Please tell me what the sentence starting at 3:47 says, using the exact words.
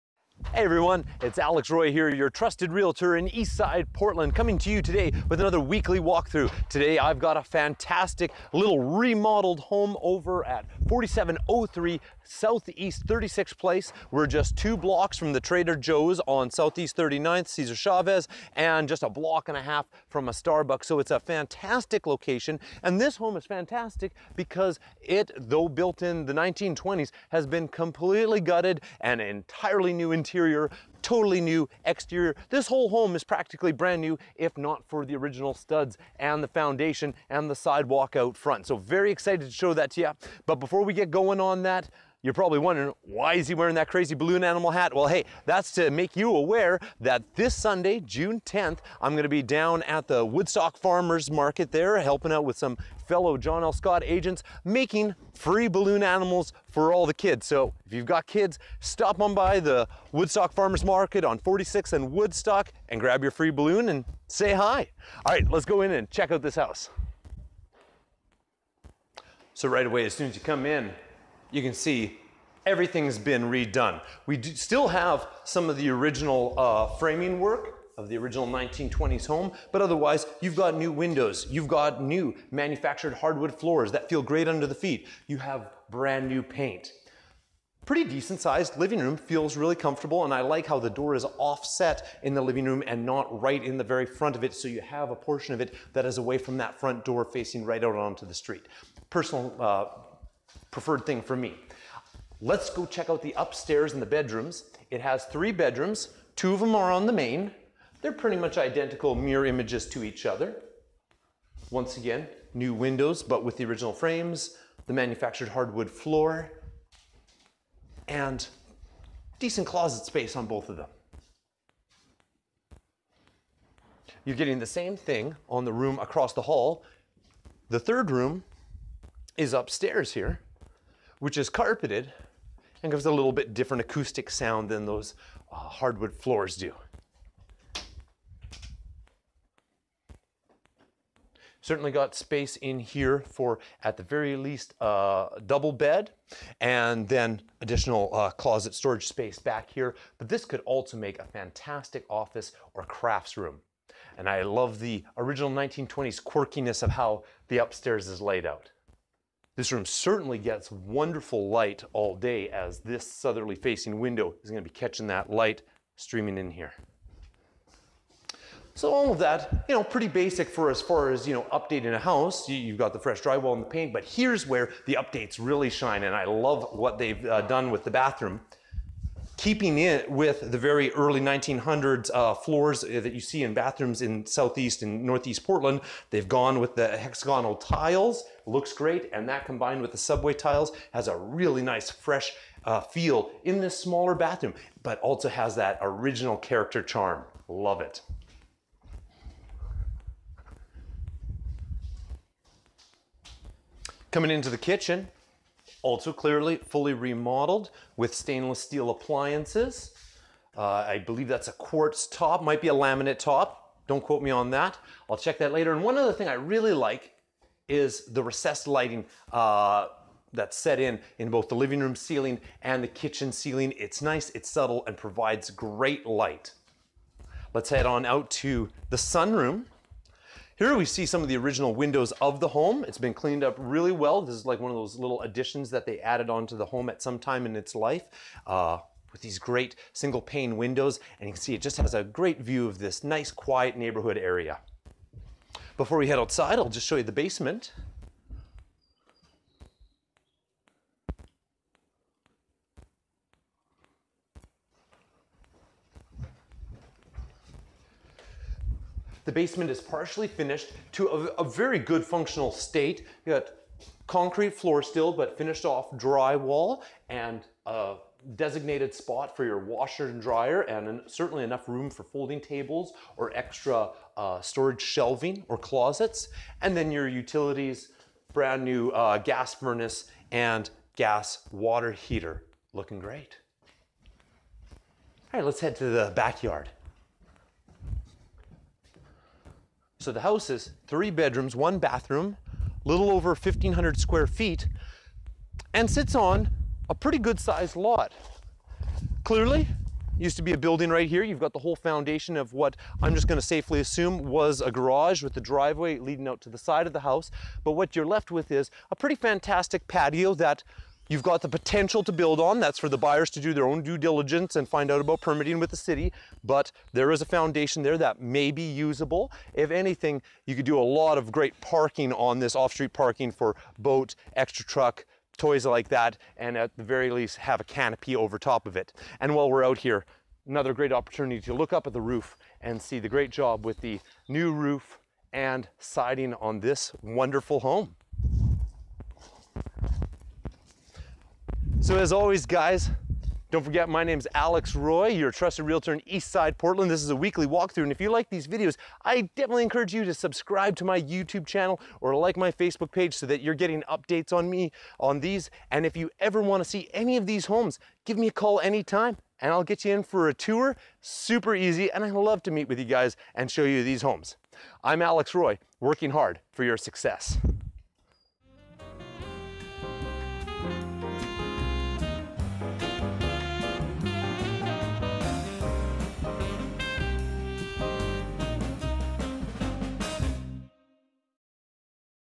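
Let's head on out to the sunroom.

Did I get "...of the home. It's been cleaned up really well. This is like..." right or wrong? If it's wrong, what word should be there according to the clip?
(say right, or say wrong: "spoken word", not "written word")
right.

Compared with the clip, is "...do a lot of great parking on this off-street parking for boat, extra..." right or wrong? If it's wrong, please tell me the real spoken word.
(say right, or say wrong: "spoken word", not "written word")
right.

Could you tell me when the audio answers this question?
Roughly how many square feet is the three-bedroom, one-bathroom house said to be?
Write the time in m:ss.
4:53.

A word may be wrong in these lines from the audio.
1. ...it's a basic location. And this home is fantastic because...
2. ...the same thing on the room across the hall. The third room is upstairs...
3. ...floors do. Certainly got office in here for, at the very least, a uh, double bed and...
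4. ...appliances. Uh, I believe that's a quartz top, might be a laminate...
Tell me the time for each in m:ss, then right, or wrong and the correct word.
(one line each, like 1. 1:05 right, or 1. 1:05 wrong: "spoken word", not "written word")
1. 0:20 wrong: "fantastic", not "basic"
2. 2:04 right
3. 2:16 wrong: "space", not "office"
4. 3:28 right.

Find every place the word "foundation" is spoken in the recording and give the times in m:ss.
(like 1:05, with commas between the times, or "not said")
0:36, 5:01, 5:17.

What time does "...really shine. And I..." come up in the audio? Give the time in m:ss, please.
2:55.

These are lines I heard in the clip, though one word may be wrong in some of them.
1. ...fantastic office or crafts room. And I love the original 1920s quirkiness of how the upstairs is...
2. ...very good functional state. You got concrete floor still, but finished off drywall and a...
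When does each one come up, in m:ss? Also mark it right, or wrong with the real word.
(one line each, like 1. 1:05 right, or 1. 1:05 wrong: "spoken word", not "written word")
1. 2:31 right
2. 4:21 right.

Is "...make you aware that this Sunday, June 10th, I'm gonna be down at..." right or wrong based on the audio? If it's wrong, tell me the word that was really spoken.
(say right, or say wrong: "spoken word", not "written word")
right.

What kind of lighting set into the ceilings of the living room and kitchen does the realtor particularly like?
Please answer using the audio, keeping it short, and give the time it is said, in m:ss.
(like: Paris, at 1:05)
Recessed lighting, at 3:38.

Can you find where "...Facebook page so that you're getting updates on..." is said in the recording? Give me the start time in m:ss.
5:52.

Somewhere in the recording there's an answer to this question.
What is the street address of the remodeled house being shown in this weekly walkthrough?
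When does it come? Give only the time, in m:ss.
0:10.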